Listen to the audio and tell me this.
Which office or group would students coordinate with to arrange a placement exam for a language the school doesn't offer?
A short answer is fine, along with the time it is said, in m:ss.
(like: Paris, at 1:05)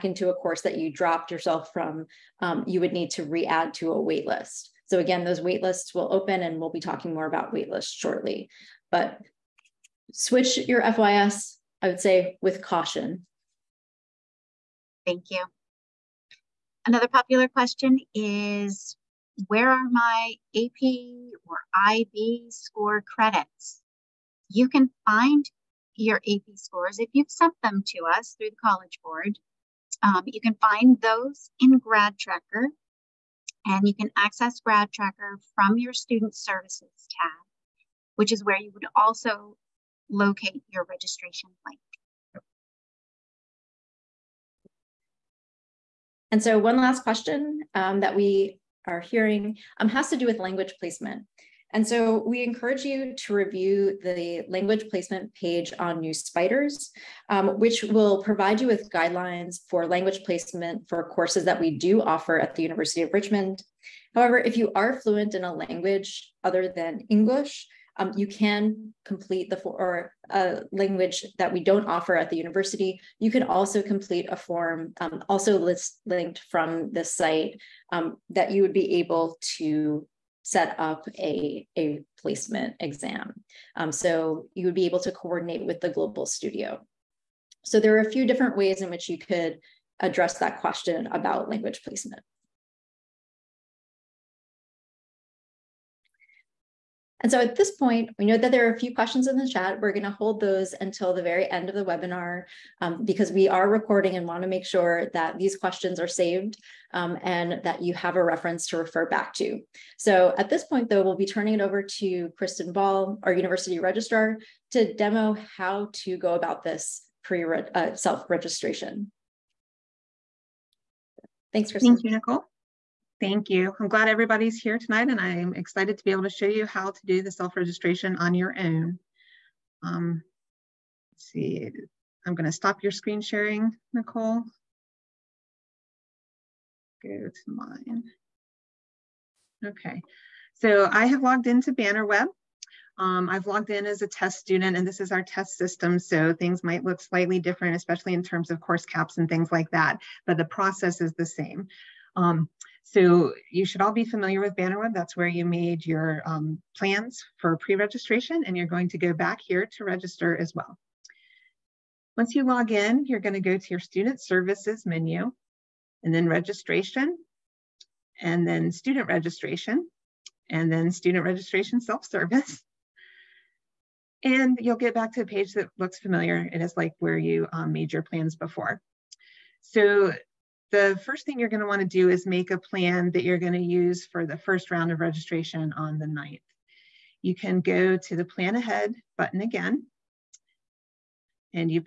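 the global studio, at 1:25.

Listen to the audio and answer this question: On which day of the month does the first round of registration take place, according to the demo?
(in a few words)
9th.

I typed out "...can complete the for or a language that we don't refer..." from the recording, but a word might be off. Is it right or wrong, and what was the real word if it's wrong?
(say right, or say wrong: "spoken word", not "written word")
wrong: "offer", not "refer".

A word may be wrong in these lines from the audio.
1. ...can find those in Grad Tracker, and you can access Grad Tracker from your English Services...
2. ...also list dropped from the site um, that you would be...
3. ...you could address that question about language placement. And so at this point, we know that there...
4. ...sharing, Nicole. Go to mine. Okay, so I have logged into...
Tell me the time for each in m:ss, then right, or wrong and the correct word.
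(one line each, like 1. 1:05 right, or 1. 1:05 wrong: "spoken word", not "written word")
1. 0:30 wrong: "Student", not "English"
2. 1:15 wrong: "linked", not "dropped"
3. 1:29 right
4. 2:13 right.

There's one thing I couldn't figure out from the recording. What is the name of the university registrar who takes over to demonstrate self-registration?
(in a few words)
Kristen Ball.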